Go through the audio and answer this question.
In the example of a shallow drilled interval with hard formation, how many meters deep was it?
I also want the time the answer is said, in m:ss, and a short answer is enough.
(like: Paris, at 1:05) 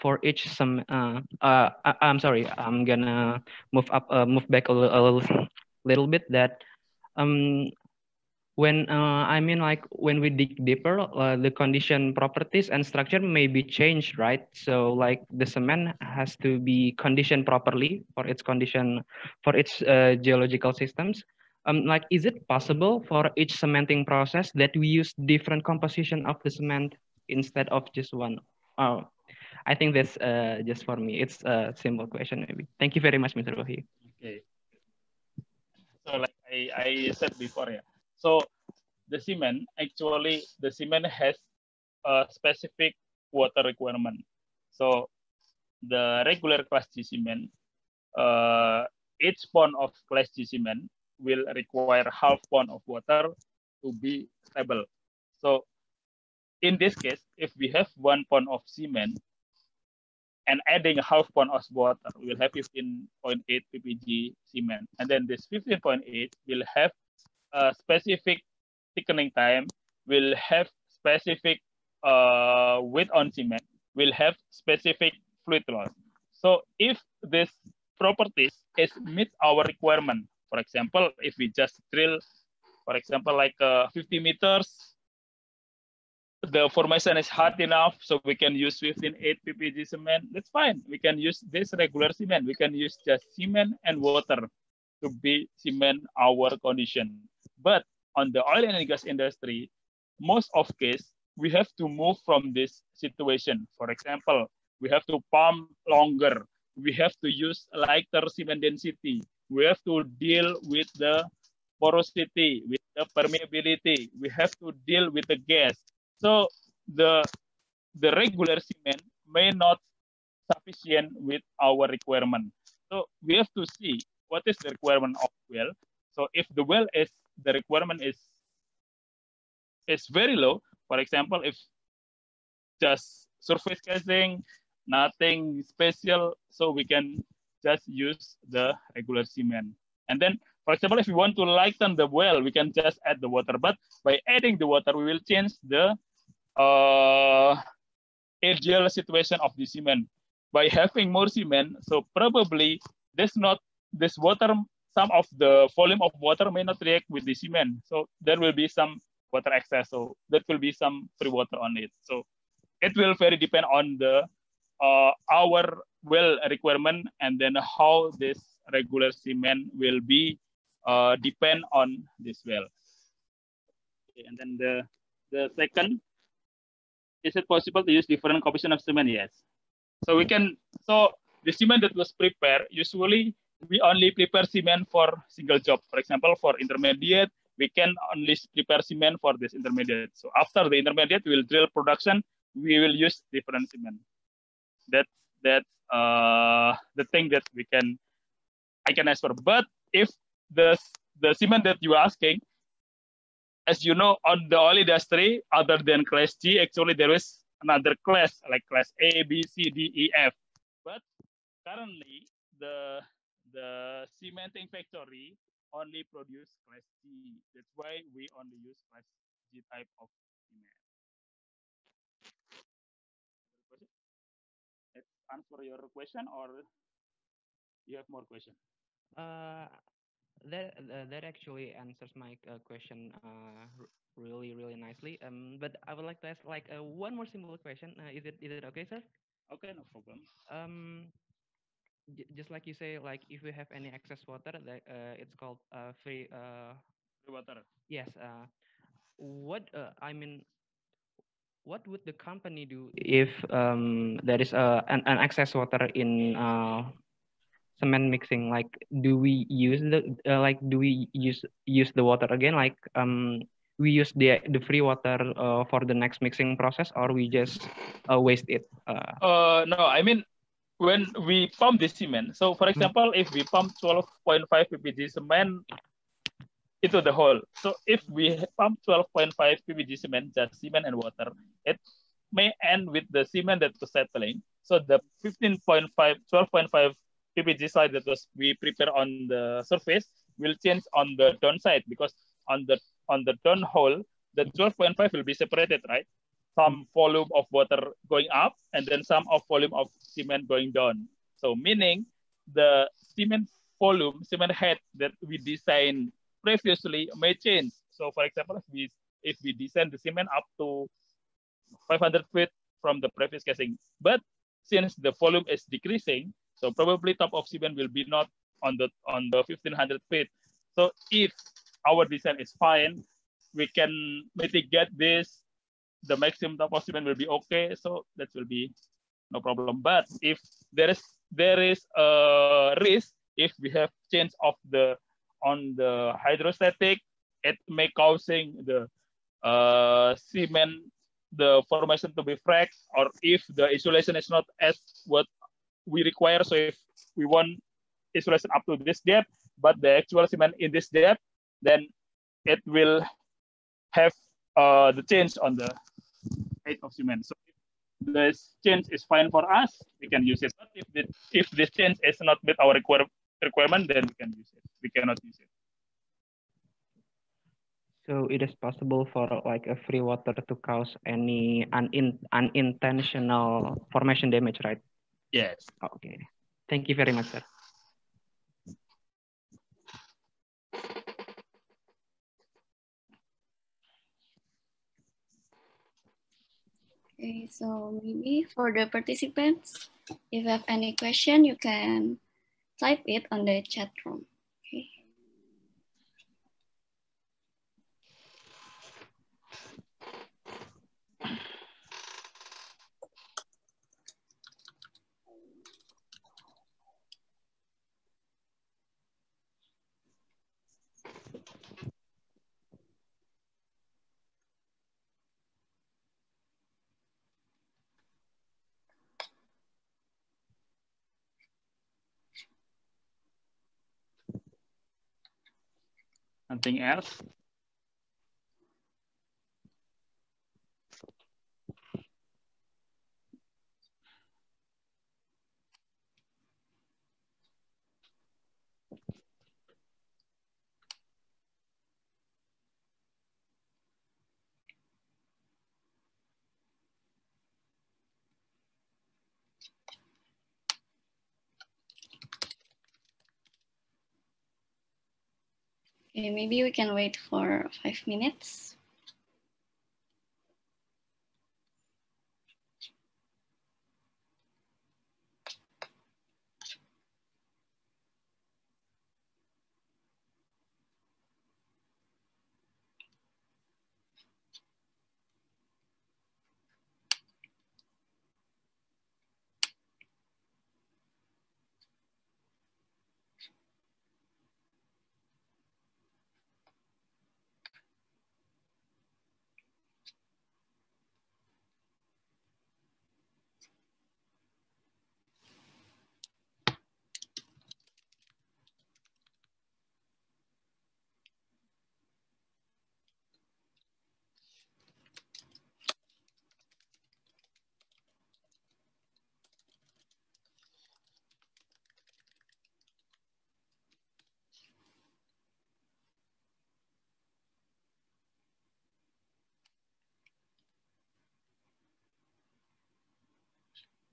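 50 meters, at 1:23.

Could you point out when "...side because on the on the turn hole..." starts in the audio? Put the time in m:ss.
4:51.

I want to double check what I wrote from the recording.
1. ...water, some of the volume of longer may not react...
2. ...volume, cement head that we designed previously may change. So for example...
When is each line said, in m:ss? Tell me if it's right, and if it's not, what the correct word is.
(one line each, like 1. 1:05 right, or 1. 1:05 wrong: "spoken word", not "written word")
1. 2:34 wrong: "water", not "longer"
2. 5:03 right.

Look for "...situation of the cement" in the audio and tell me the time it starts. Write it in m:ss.
2:28.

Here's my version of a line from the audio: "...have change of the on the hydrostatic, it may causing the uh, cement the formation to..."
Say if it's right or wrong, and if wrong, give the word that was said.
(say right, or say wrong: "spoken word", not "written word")
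right.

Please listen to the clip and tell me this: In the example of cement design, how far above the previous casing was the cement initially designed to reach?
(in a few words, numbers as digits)
500 feet.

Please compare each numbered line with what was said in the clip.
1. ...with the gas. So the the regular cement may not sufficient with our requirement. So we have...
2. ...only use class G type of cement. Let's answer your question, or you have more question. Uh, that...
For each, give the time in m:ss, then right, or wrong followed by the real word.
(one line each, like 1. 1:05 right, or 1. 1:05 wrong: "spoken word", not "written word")
1. 1:55 right
2. 3:38 right.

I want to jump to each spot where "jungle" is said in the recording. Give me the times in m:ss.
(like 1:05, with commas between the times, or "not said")
not said.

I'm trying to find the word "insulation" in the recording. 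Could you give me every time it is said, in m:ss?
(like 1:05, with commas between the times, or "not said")
5:43, 5:48.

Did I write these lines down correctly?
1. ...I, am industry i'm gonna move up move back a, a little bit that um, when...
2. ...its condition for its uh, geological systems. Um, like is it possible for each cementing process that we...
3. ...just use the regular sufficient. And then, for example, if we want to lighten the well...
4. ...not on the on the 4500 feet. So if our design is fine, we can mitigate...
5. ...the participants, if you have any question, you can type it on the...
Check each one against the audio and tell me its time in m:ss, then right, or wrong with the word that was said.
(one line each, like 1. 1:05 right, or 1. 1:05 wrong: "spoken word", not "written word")
1. 0:01 wrong: "sorry", not "industry"
2. 0:18 right
3. 2:17 wrong: "cement", not "sufficient"
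4. 5:18 wrong: "1500", not "4500"
5. 6:28 right.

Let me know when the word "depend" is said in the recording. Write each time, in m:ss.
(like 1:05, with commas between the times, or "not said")
2:43, 2:51.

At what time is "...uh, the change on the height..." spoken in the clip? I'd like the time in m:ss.
5:54.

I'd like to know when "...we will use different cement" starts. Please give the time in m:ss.
3:12.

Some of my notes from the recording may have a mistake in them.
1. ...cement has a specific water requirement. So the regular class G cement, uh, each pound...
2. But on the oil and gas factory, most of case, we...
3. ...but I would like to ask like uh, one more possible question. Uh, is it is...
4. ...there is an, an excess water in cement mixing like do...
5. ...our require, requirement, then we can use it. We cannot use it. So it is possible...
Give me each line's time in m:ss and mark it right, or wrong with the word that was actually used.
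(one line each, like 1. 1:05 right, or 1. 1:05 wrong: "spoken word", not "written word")
1. 0:40 right
2. 1:37 wrong: "industry", not "factory"
3. 3:55 wrong: "simple", not "possible"
4. 4:14 right
5. 6:02 right.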